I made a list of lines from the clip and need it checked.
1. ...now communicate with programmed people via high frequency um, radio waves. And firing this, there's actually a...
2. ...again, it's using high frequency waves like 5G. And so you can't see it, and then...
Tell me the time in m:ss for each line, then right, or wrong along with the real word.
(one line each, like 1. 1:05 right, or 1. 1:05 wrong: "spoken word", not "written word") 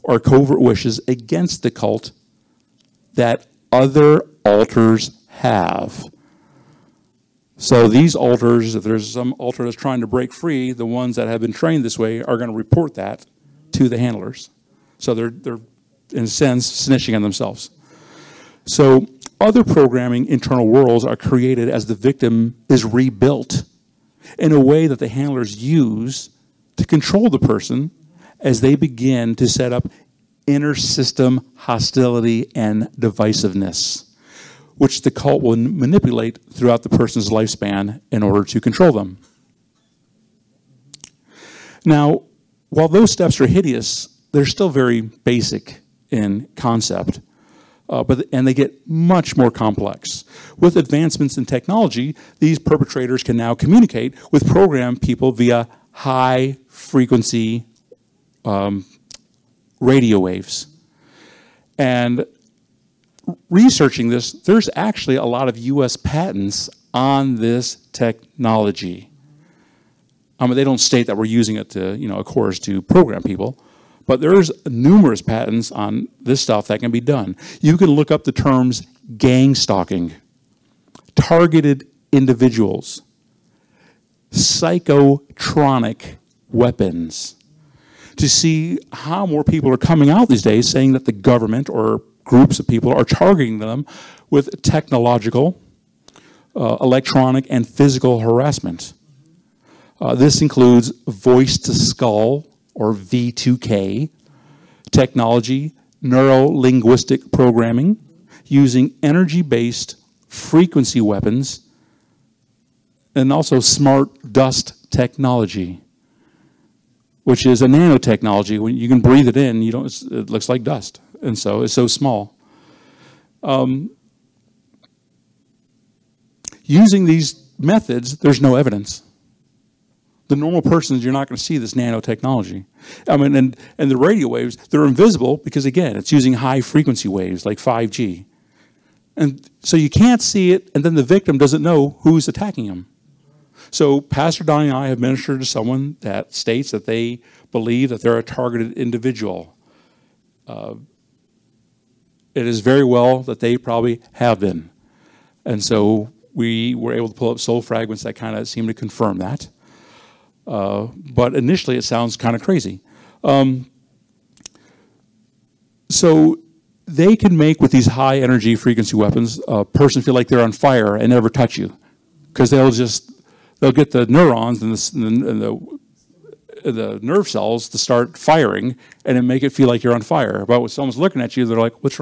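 1. 0:53 wrong: "researching", not "firing"
2. 2:15 right.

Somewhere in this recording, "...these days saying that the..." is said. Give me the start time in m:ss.
1:30.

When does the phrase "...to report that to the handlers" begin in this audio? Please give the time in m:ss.
0:12.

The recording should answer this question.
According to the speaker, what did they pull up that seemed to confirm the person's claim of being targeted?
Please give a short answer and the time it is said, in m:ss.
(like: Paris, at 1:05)
soul fragments, at 2:37.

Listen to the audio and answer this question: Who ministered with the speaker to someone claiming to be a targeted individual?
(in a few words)
Pastor Donnie.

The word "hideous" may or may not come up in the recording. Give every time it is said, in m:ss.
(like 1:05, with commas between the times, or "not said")
0:43.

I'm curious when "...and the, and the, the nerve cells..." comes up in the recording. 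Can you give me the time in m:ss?
2:54.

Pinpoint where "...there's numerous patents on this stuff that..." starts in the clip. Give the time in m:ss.
1:14.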